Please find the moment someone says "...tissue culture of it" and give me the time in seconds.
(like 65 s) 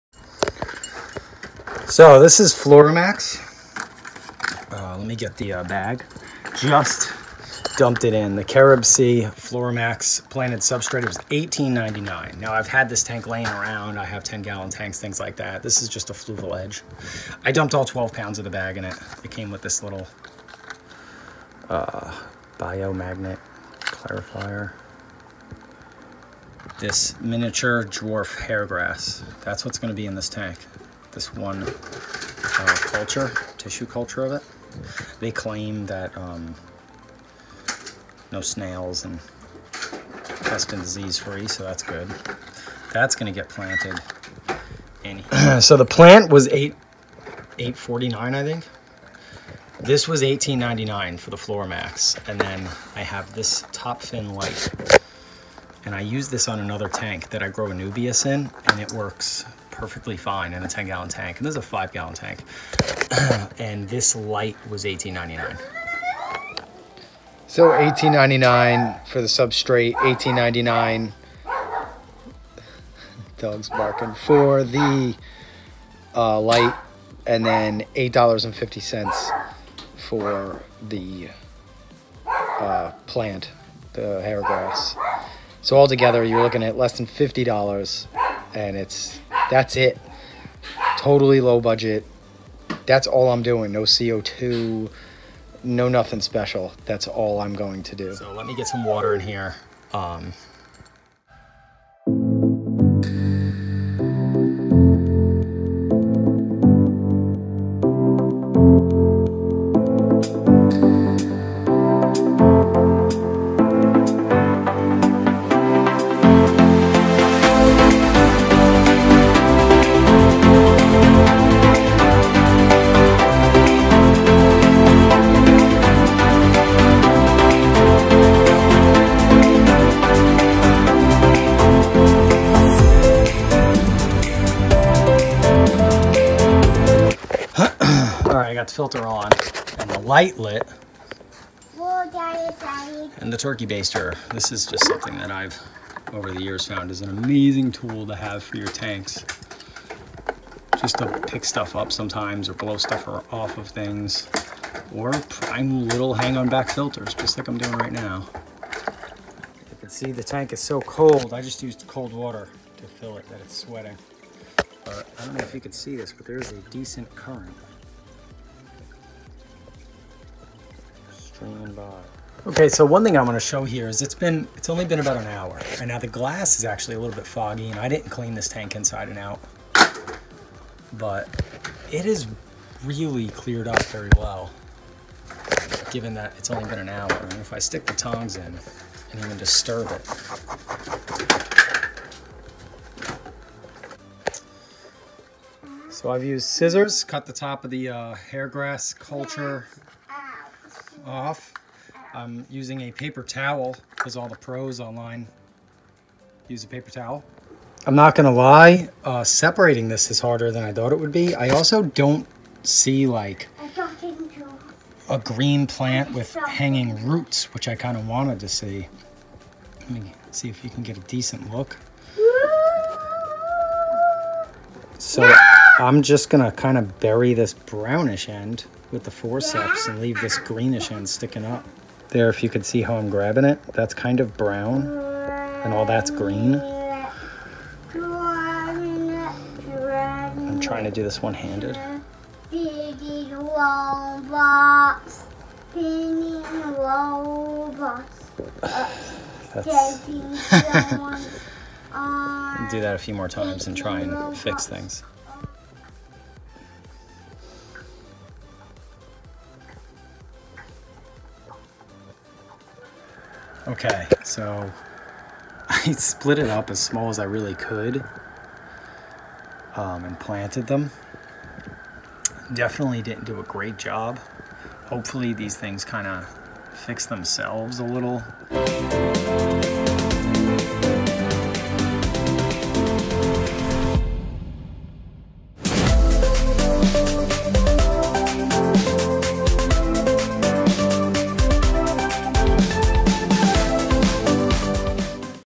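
33 s.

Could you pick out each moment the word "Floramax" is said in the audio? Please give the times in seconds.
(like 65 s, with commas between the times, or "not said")
2 s, 9 s.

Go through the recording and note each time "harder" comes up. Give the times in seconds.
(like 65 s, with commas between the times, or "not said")
210 s.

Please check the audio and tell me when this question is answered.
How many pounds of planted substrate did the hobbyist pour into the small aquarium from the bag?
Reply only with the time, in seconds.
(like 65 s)
17 s.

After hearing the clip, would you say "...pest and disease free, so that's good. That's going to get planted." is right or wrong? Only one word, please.
right.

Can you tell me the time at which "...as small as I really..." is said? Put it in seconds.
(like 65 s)
266 s.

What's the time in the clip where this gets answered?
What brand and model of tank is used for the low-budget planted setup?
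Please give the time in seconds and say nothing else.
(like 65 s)
16 s.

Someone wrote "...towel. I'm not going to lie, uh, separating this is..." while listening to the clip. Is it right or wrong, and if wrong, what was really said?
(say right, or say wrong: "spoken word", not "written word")
right.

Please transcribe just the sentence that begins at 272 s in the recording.
Definitely didn't do a great job.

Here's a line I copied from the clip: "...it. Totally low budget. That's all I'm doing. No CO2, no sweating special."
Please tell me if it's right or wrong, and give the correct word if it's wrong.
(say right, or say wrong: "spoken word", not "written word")
wrong: "nothing", not "sweating".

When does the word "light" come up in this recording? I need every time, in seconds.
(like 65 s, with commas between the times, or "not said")
54 s, 64 s, 76 s, 140 s.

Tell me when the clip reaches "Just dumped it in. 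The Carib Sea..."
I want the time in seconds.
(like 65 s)
6 s.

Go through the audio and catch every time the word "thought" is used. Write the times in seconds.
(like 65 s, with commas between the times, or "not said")
210 s.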